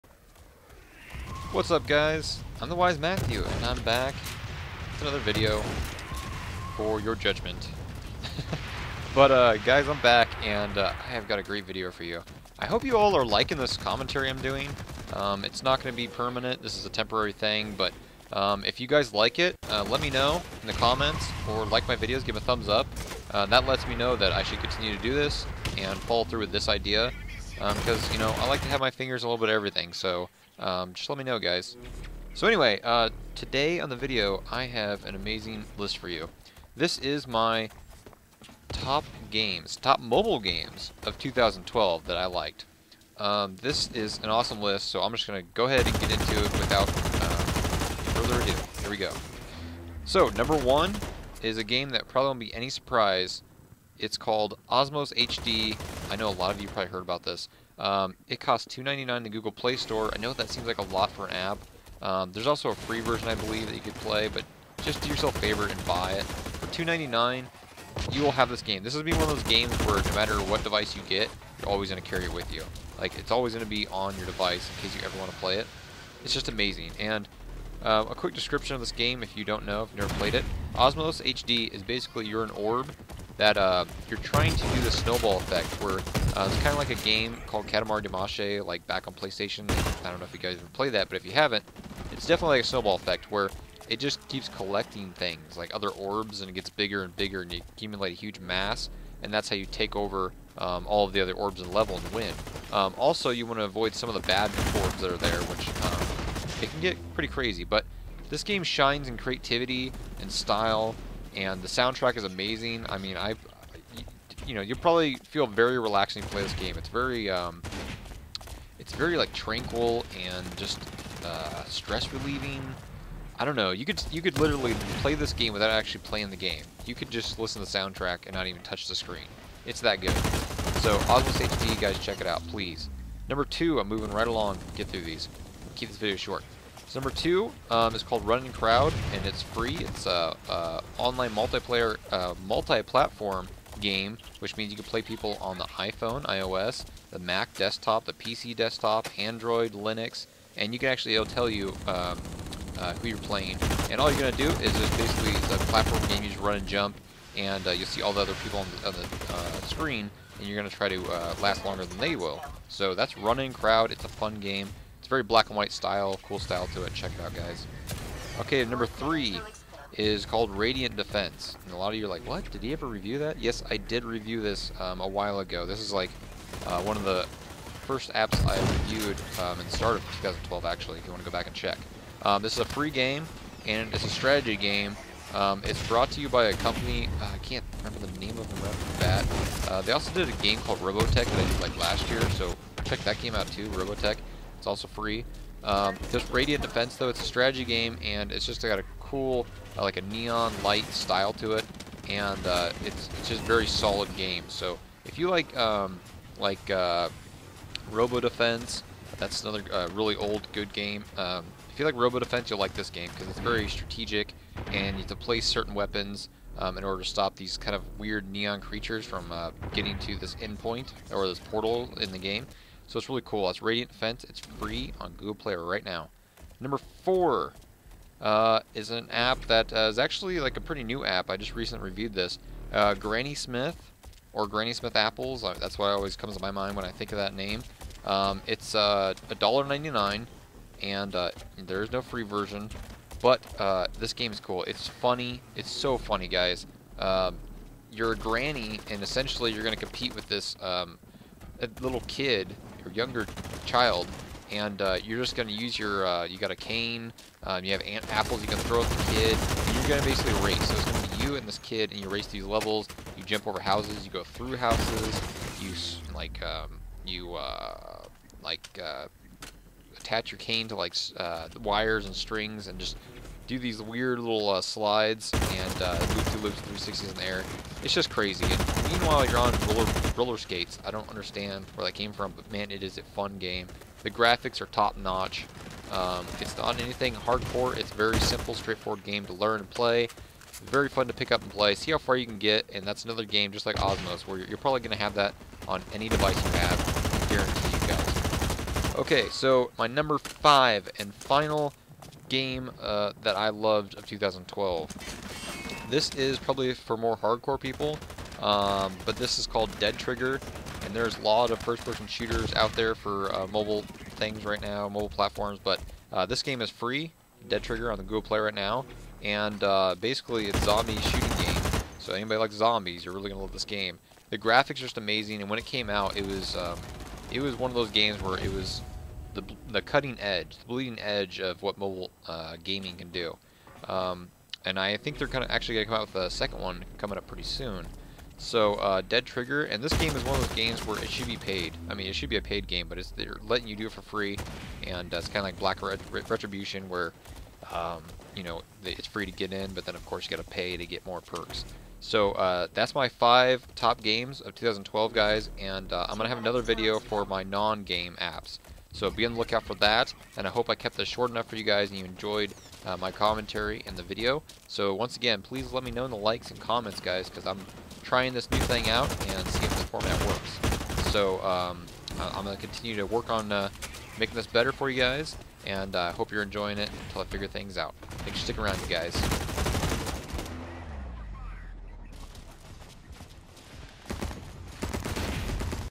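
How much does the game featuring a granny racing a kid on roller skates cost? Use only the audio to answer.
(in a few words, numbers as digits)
$1.99.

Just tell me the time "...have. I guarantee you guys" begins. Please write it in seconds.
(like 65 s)
296 s.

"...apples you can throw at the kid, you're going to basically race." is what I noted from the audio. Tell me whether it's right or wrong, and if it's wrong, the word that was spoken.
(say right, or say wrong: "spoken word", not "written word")
right.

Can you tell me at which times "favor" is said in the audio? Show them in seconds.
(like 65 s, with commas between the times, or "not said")
65 s.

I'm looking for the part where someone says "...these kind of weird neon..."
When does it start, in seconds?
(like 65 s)
217 s.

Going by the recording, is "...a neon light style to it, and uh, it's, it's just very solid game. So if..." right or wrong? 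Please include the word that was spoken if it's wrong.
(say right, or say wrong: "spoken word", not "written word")
right.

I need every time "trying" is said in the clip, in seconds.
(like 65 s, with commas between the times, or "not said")
84 s, 368 s.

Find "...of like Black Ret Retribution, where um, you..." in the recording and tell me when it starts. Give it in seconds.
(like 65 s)
345 s.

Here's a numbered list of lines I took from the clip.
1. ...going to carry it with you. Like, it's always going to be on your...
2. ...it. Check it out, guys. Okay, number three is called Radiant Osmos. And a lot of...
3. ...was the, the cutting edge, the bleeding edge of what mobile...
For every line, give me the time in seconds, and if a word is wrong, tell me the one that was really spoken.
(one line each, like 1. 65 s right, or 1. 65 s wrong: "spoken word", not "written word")
1. 71 s right
2. 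166 s wrong: "Defense", not "Osmos"
3. 328 s right.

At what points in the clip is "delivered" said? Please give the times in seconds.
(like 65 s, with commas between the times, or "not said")
not said.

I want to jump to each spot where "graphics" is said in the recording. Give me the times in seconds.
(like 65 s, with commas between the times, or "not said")
284 s, 324 s.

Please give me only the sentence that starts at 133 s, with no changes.
Number two, I'm moving right along.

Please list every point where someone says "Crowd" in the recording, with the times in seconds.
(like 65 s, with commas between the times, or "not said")
138 s, 163 s.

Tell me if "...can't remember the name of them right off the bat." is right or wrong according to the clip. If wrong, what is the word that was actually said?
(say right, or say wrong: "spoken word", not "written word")
right.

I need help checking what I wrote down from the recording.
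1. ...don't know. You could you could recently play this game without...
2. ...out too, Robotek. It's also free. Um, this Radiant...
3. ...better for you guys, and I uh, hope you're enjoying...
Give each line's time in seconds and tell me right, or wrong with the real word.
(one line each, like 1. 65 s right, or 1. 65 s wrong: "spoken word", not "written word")
1. 123 s wrong: "literally", not "recently"
2. 193 s right
3. 374 s right.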